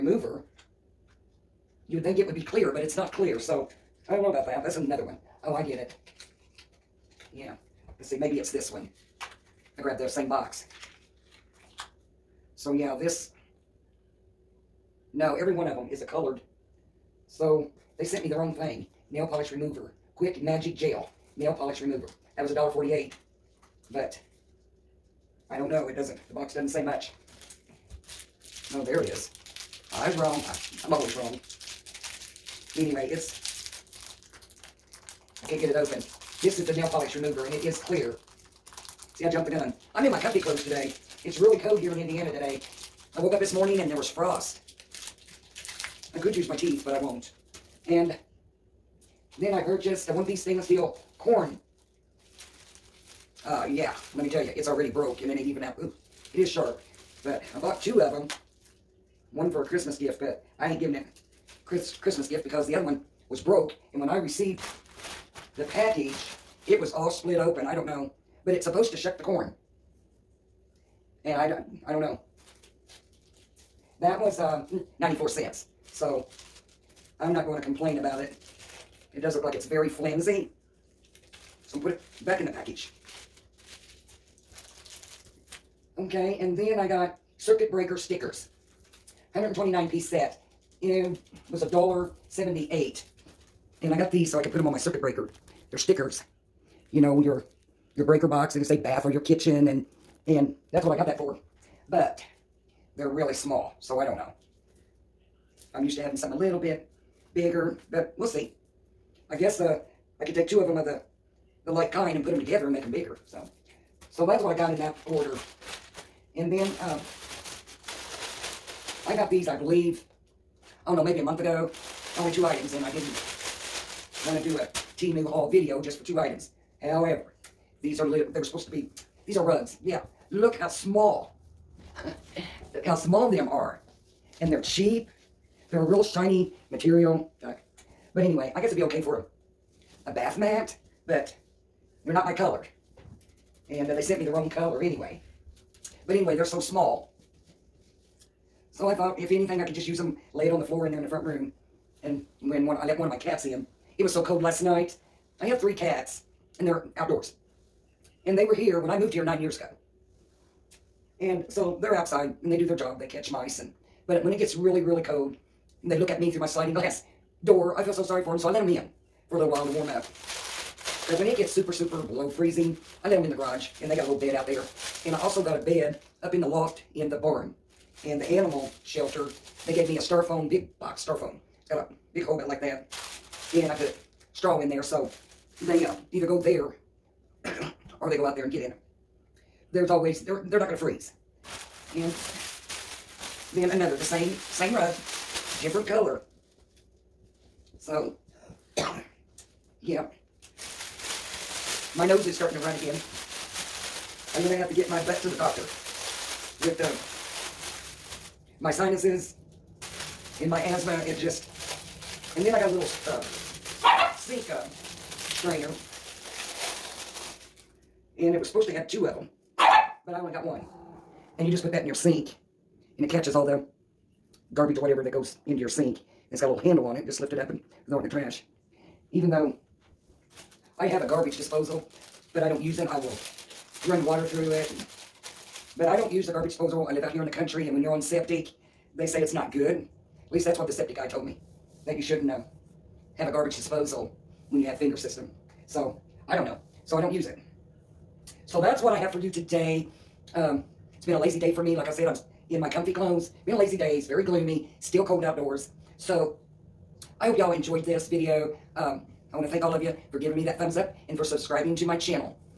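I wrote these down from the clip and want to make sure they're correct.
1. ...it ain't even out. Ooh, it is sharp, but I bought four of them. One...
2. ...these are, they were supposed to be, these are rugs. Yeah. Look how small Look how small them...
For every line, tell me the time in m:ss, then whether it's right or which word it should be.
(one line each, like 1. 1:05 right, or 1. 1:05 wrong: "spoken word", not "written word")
1. 0:55 wrong: "two", not "four"
2. 2:07 right.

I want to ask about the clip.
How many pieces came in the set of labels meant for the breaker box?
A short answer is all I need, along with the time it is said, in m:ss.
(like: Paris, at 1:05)
129, at 1:29.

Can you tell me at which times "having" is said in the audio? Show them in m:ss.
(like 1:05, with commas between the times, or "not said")
1:46.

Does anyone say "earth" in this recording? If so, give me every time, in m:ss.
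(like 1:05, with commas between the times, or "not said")
not said.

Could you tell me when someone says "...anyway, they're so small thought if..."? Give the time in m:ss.
2:26.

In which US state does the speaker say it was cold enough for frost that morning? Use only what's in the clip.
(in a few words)
Indiana.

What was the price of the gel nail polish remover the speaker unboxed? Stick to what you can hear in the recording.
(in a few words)
$1.48.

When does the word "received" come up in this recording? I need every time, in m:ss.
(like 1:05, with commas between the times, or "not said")
1:04.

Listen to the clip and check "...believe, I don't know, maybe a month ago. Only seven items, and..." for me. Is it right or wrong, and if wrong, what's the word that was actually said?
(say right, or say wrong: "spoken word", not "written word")
wrong: "two", not "seven".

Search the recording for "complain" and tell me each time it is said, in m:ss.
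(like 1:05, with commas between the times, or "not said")
1:17.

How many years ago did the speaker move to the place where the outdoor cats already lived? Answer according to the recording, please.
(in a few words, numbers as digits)
9.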